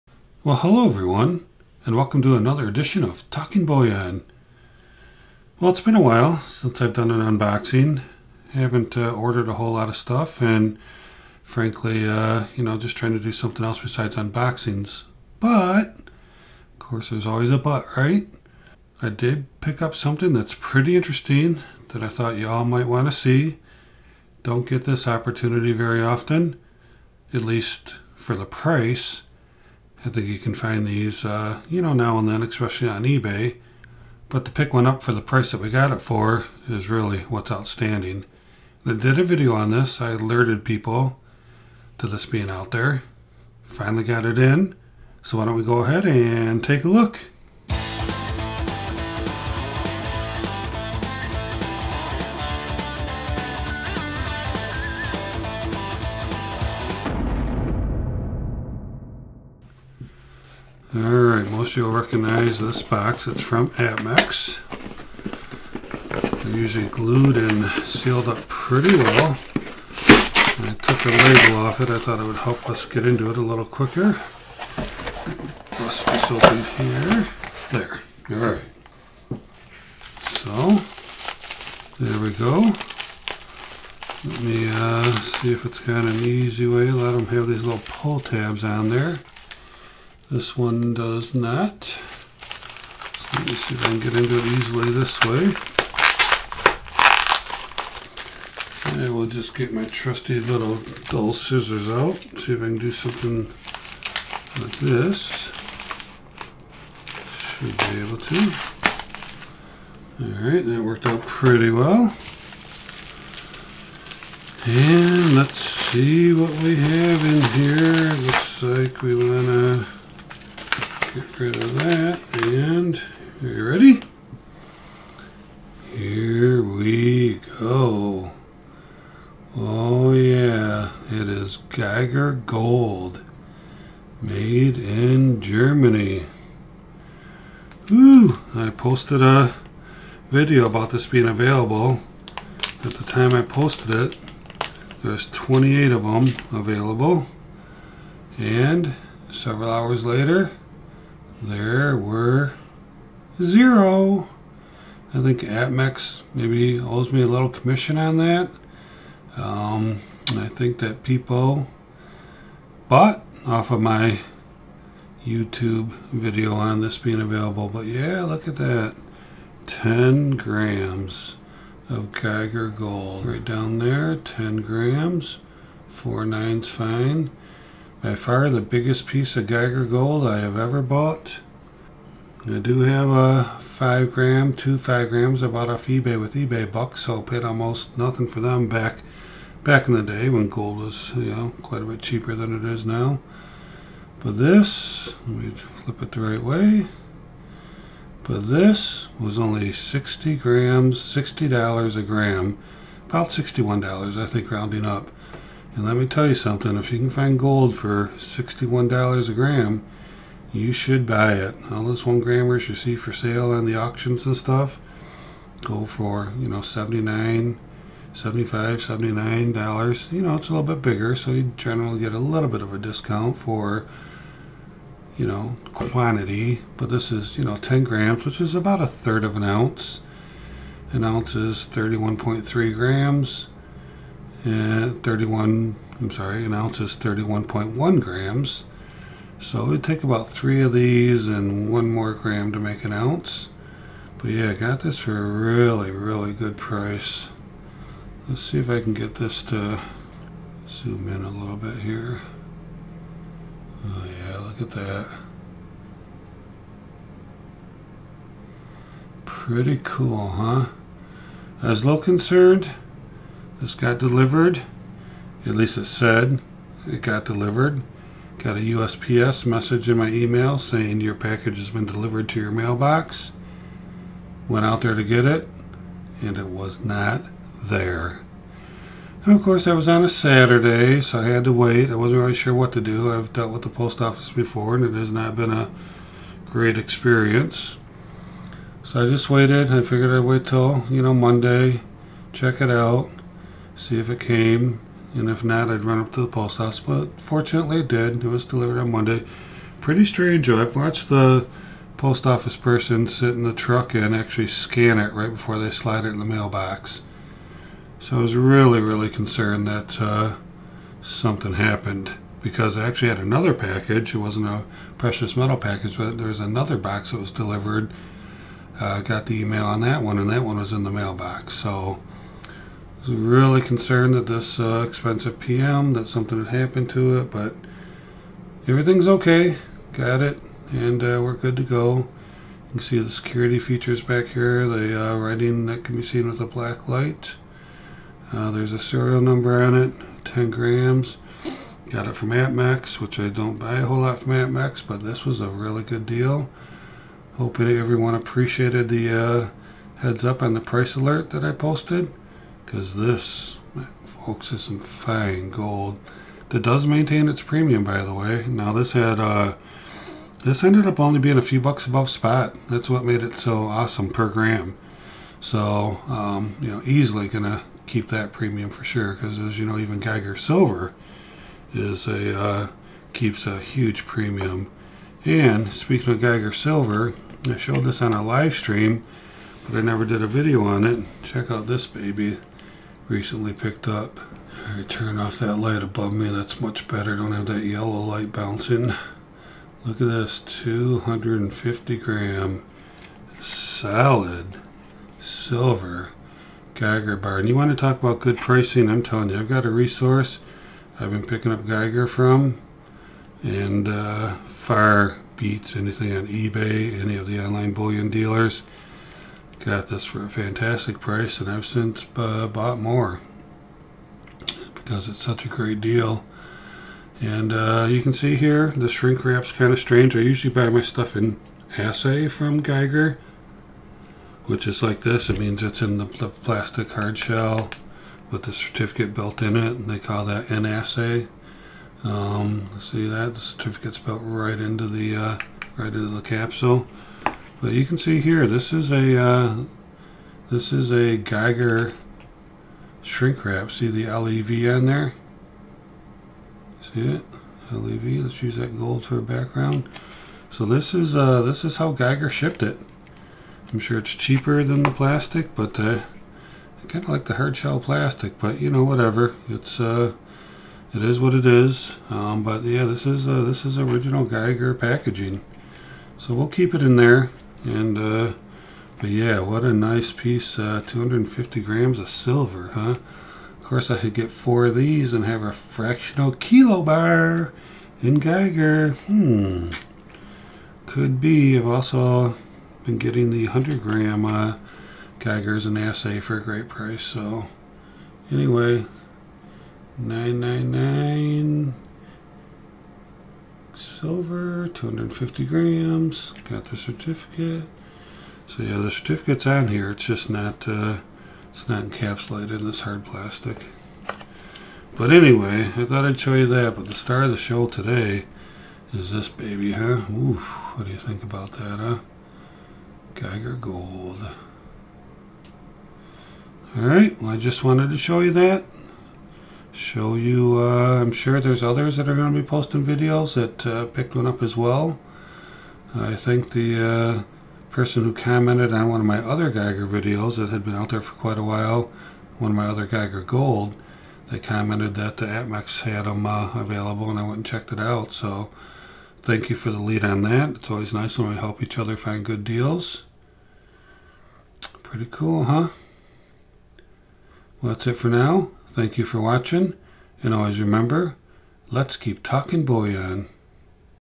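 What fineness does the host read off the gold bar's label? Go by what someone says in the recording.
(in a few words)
Four nines fine.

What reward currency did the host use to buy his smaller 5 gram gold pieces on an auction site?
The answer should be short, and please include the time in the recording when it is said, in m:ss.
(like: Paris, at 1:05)
eBay bucks, at 3:06.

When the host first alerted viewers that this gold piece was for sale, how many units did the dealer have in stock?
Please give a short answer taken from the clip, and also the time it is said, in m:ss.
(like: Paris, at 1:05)
28, at 2:25.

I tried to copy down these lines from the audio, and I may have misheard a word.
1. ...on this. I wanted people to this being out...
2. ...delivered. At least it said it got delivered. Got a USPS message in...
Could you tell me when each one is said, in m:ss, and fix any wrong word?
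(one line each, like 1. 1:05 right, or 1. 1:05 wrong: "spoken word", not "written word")
1. 0:39 wrong: "alerted", not "wanted"
2. 4:23 right.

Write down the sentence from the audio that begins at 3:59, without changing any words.
So it would take about three of these and one more gram to make an ounce.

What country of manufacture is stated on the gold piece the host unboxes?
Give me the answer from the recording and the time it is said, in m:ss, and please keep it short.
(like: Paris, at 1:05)
Germany, at 2:15.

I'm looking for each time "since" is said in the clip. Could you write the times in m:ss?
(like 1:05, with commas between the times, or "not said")
0:06, 6:51.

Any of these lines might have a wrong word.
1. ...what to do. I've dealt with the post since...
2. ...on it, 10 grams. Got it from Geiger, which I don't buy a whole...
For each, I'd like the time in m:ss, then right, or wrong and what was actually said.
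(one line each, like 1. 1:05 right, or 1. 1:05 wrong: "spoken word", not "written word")
1. 4:42 wrong: "office", not "since"
2. 5:39 wrong: "Apmex", not "Geiger".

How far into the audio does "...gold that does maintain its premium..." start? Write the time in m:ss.
5:55.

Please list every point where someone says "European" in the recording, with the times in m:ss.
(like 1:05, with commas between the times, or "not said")
not said.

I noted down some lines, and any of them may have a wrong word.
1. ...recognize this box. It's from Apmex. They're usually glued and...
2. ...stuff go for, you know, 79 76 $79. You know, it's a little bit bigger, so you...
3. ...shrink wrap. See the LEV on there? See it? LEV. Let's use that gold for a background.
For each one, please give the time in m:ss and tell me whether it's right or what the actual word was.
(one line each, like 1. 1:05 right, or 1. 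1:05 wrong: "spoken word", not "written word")
1. 1:02 right
2. 3:34 wrong: "75", not "76"
3. 7:23 right.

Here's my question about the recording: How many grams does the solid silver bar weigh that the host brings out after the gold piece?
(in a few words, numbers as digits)
250.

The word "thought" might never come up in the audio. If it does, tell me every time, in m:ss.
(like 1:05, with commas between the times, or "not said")
0:22, 1:11, 8:25.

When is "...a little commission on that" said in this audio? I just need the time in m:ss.
2:37.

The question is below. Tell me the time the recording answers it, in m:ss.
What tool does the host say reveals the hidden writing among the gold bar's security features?
5:36.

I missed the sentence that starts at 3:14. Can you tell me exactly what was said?
But this, let me flip it the right way.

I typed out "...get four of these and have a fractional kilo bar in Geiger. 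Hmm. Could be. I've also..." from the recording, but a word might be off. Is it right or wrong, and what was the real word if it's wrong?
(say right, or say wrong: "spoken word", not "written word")
right.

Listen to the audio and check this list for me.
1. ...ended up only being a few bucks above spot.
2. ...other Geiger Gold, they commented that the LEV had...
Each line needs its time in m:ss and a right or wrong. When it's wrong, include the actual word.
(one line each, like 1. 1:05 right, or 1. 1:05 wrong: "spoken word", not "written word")
1. 6:00 right
2. 8:52 wrong: "Apmex", not "LEV".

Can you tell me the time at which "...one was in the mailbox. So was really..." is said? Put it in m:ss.
5:20.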